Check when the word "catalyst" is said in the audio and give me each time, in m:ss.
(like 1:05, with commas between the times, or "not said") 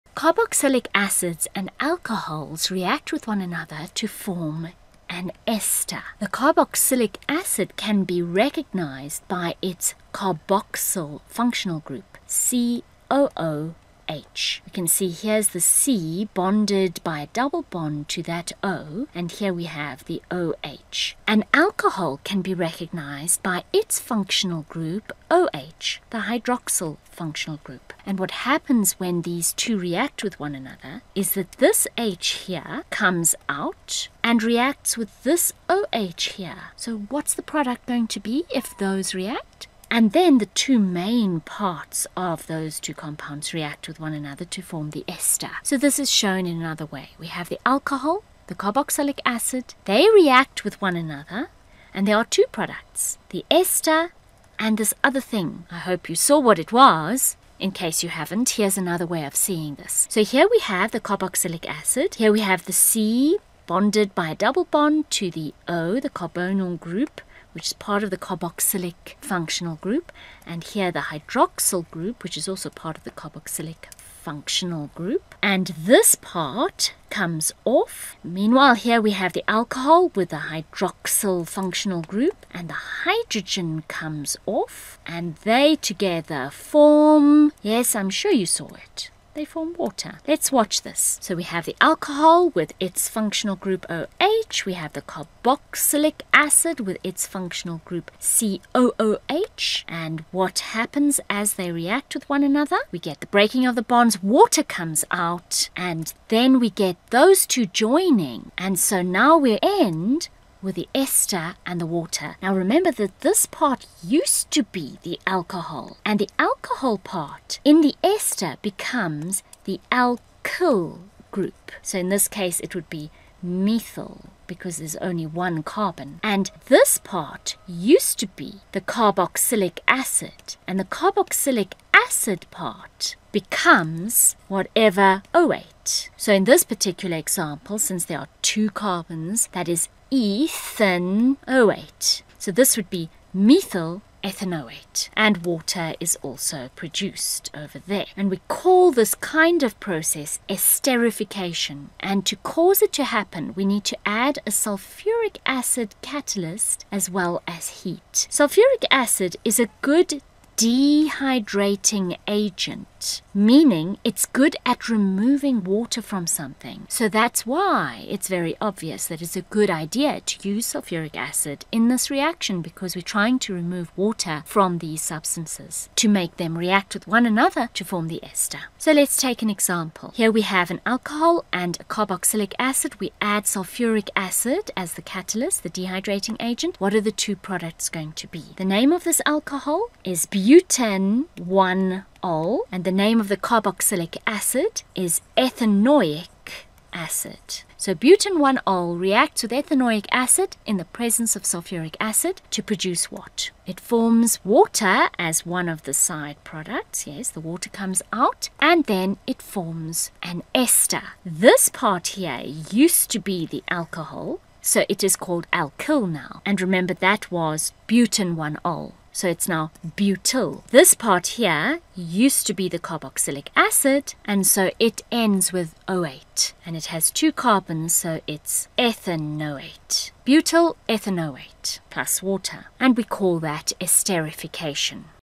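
2:36, 3:05.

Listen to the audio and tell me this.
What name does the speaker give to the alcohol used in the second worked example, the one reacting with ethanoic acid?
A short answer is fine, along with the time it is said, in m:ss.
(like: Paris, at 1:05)
butan-1-ol, at 3:10.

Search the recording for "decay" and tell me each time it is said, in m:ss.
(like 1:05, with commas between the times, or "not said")
not said.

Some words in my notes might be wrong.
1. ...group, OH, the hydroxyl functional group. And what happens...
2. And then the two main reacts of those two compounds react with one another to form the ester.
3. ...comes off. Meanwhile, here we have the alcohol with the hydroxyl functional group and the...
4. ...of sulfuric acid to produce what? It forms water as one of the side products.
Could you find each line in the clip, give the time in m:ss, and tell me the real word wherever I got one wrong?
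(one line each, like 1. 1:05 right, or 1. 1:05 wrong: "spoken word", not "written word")
1. 0:24 right
2. 0:39 wrong: "parts", not "reacts"
3. 1:17 right
4. 3:21 right.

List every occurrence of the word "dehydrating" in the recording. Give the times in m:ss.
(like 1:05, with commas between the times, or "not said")
2:40, 3:05.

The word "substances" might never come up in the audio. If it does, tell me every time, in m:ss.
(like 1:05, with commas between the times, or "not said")
2:55.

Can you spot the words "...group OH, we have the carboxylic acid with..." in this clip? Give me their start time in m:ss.
1:33.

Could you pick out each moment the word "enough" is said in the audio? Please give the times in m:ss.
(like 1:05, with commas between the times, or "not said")
not said.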